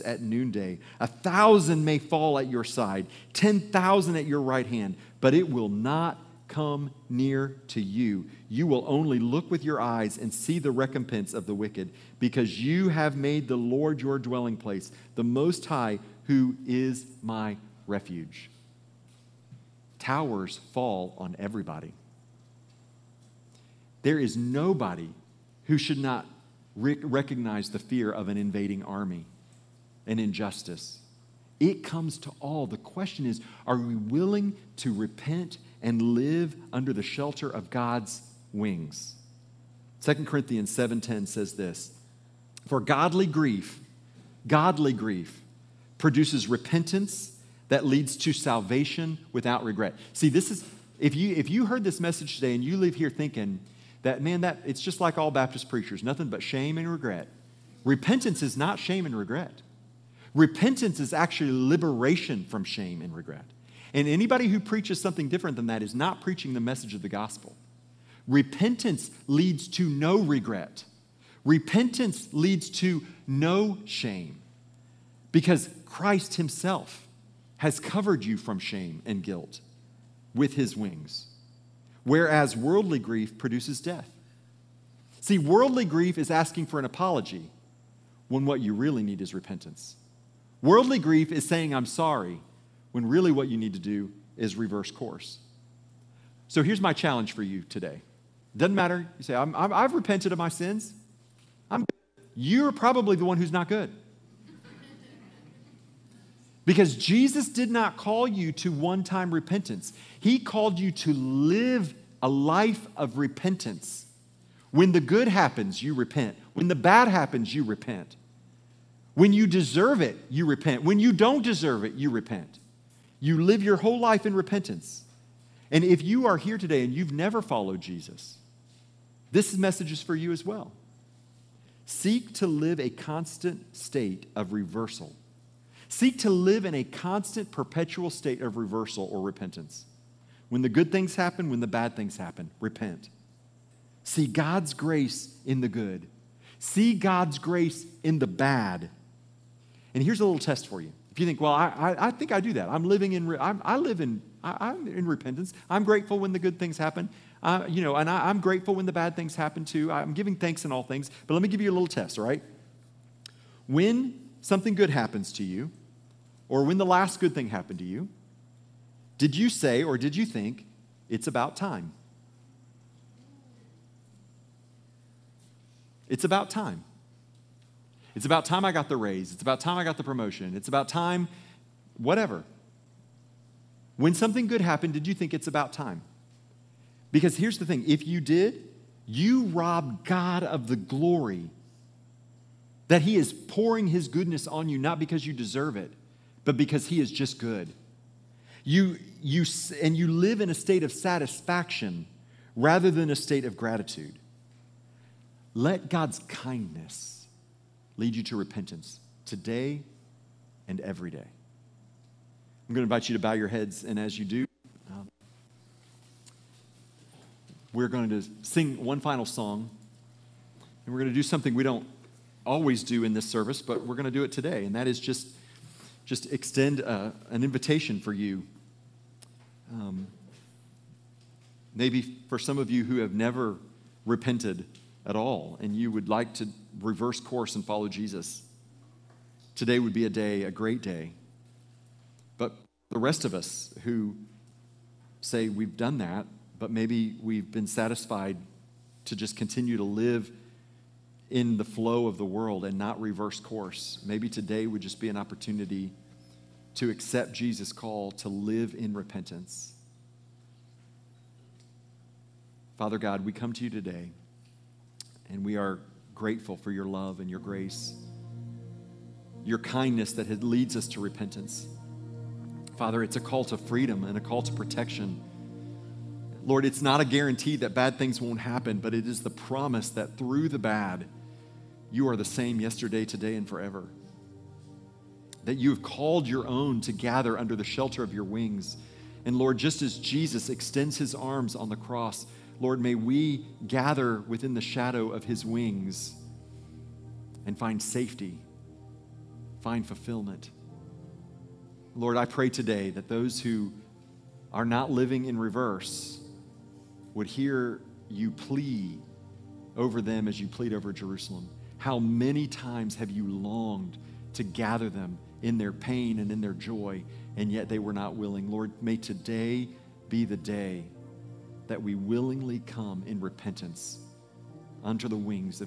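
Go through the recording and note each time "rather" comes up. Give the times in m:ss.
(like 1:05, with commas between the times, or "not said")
3:22.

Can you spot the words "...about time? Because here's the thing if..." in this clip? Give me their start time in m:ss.
3:05.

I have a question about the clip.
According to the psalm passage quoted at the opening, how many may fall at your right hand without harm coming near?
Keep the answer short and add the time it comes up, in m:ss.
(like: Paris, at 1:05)
10,000, at 0:03.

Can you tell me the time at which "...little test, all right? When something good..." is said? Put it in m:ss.
2:41.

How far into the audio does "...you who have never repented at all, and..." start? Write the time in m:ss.
3:52.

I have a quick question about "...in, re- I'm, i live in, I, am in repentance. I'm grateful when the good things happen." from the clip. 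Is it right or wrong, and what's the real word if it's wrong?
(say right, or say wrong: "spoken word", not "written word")
right.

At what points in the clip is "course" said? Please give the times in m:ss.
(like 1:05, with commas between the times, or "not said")
1:34, 3:57, 4:13.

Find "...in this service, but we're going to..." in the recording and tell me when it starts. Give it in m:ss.
3:43.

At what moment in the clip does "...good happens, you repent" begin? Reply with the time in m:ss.
1:54.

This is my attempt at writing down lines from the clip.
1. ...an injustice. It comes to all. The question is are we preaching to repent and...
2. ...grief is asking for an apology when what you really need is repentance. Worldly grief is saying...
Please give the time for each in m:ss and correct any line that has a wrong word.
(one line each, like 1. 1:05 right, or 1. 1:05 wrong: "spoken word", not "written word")
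1. 0:30 wrong: "willing", not "preaching"
2. 1:25 right.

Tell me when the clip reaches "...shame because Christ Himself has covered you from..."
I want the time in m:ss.
1:13.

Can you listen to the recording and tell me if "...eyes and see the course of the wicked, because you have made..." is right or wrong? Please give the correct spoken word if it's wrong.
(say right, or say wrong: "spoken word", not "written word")
wrong: "recompense", not "course".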